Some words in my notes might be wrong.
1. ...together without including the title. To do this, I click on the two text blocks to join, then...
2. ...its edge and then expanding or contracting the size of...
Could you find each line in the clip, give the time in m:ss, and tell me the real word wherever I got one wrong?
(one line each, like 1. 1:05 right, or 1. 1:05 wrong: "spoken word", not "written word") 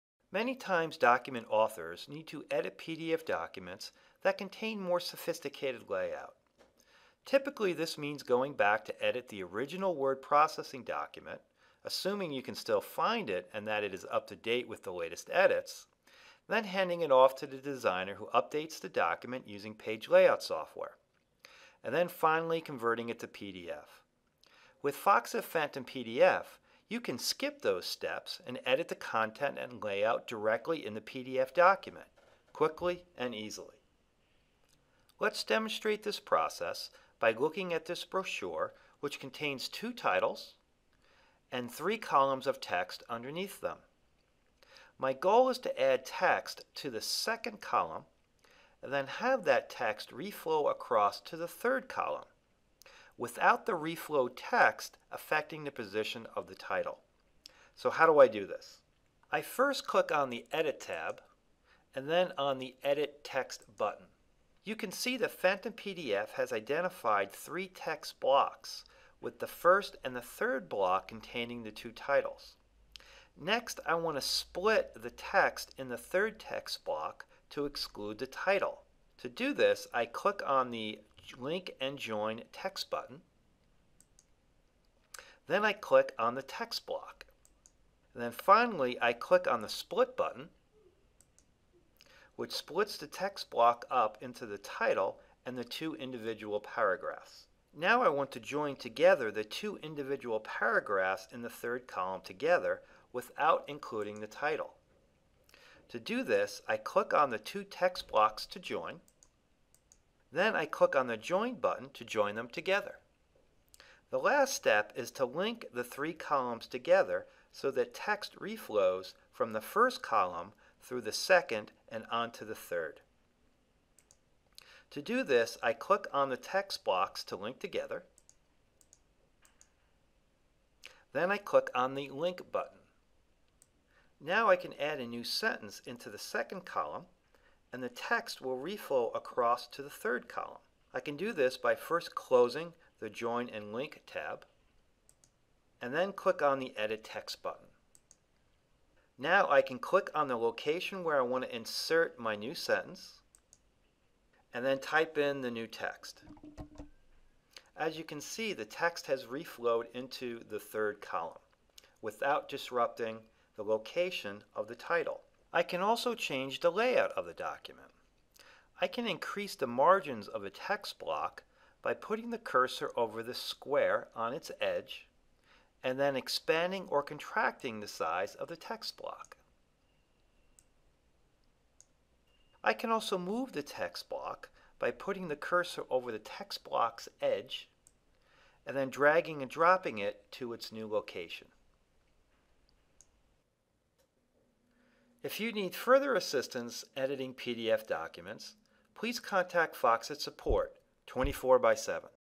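1. 1:42 right
2. 2:54 right.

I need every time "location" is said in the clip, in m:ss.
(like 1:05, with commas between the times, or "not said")
2:30, 2:43, 3:10.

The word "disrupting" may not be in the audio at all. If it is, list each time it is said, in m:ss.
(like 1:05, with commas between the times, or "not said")
2:42.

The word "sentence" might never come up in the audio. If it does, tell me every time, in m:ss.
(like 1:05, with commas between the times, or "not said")
2:15, 2:32.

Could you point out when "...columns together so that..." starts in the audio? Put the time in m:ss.
1:56.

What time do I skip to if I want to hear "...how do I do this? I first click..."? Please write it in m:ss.
0:57.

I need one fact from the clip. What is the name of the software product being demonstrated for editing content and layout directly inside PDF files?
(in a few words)
Foxit Phantom PDF.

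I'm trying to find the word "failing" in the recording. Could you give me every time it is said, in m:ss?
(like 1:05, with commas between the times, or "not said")
not said.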